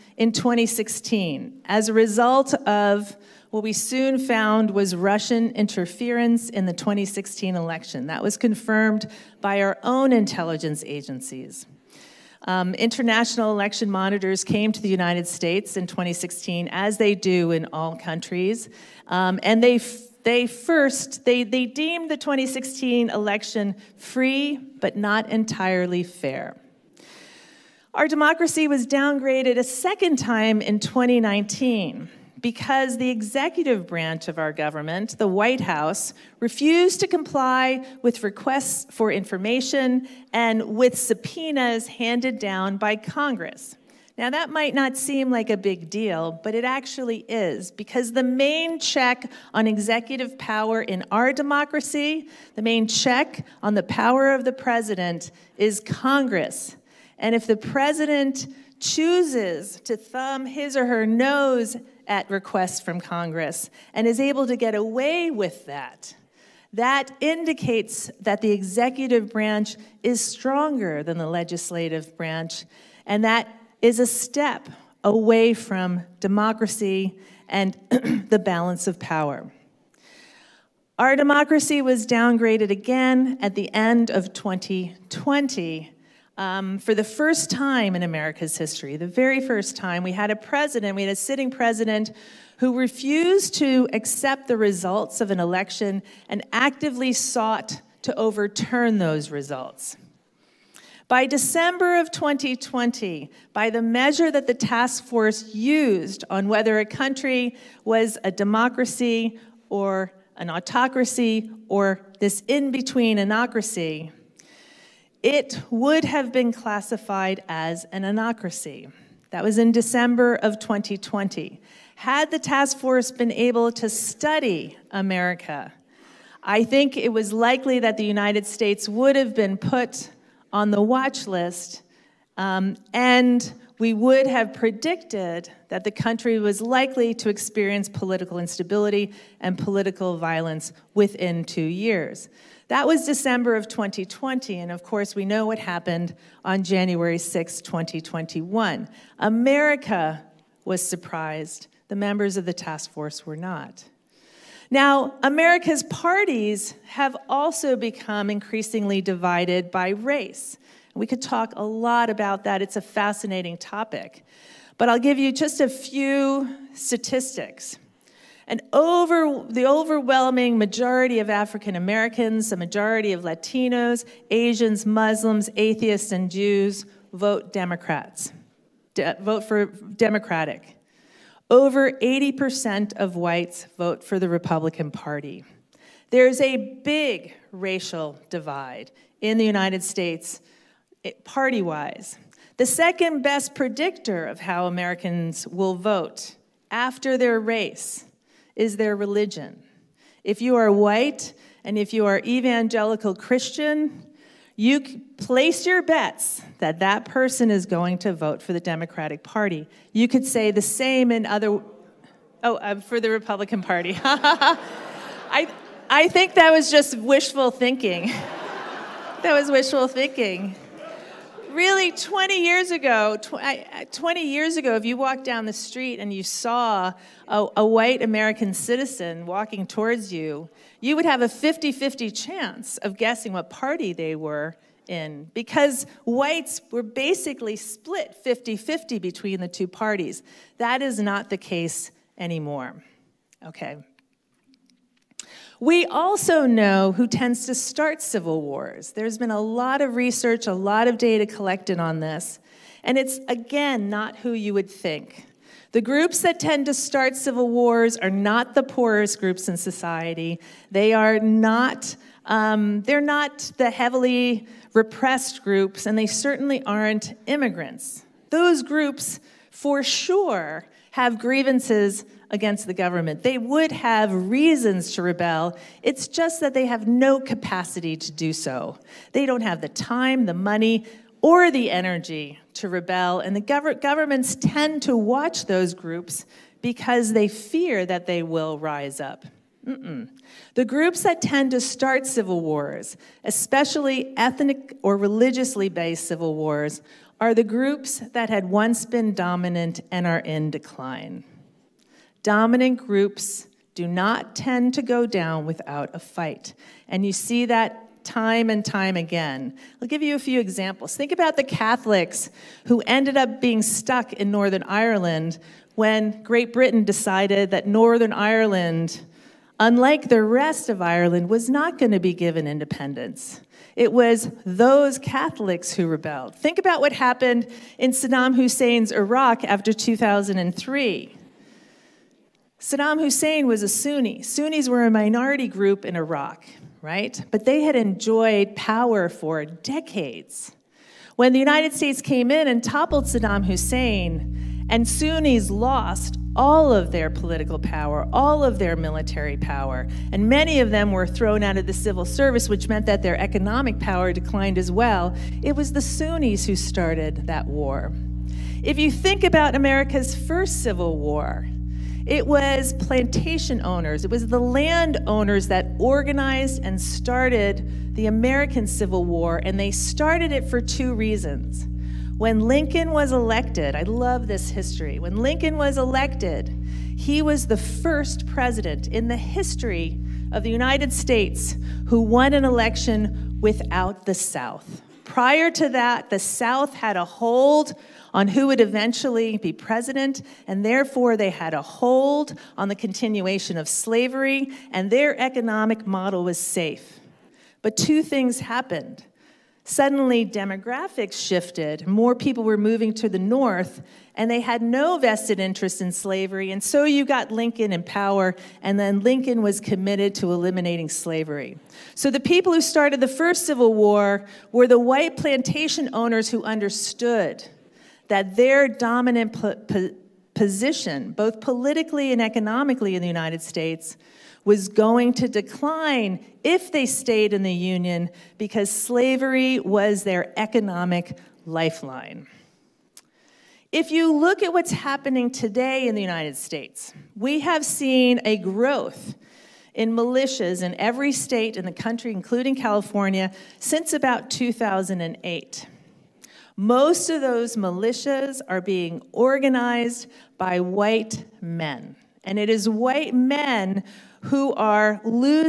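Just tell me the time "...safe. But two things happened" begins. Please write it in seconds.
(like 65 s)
396 s.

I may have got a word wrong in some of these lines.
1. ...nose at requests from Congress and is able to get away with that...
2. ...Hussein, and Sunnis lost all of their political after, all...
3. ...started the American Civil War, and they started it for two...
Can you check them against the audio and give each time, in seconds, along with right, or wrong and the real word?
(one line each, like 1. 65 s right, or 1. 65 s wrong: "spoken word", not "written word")
1. 61 s right
2. 343 s wrong: "power", not "after"
3. 366 s right.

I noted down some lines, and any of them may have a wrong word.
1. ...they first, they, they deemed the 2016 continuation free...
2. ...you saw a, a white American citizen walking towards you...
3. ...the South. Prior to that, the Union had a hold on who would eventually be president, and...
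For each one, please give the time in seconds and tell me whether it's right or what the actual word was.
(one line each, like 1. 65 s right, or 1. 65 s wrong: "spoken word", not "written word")
1. 20 s wrong: "election", not "continuation"
2. 226 s right
3. 384 s wrong: "South", not "Union".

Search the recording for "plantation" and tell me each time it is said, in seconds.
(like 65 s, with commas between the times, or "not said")
362 s, 415 s.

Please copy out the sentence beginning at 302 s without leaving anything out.
Dominant groups do not tend to go down without a fight.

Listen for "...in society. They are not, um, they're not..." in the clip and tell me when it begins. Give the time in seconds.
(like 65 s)
259 s.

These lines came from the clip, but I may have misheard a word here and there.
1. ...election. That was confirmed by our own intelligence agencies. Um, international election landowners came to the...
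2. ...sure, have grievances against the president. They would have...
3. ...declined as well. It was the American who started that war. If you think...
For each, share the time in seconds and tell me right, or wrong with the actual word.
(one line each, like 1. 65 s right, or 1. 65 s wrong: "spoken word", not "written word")
1. 7 s wrong: "monitors", not "landowners"
2. 269 s wrong: "government", not "president"
3. 354 s wrong: "Sunnis", not "American".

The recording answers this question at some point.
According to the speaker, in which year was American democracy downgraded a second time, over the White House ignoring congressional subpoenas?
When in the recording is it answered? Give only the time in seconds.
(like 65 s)
30 s.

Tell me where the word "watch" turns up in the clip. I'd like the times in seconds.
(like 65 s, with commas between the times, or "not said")
130 s, 284 s.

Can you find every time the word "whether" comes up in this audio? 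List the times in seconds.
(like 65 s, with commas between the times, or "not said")
106 s.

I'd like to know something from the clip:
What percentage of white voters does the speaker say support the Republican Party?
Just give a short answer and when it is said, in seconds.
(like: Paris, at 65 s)
over 80%, at 181 s.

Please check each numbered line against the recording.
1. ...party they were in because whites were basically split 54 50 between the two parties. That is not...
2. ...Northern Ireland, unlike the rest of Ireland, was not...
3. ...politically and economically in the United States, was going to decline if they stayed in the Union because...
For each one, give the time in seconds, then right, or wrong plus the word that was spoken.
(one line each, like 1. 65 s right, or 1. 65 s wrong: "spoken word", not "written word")
1. 233 s wrong: "50", not "54"
2. 317 s right
3. 421 s right.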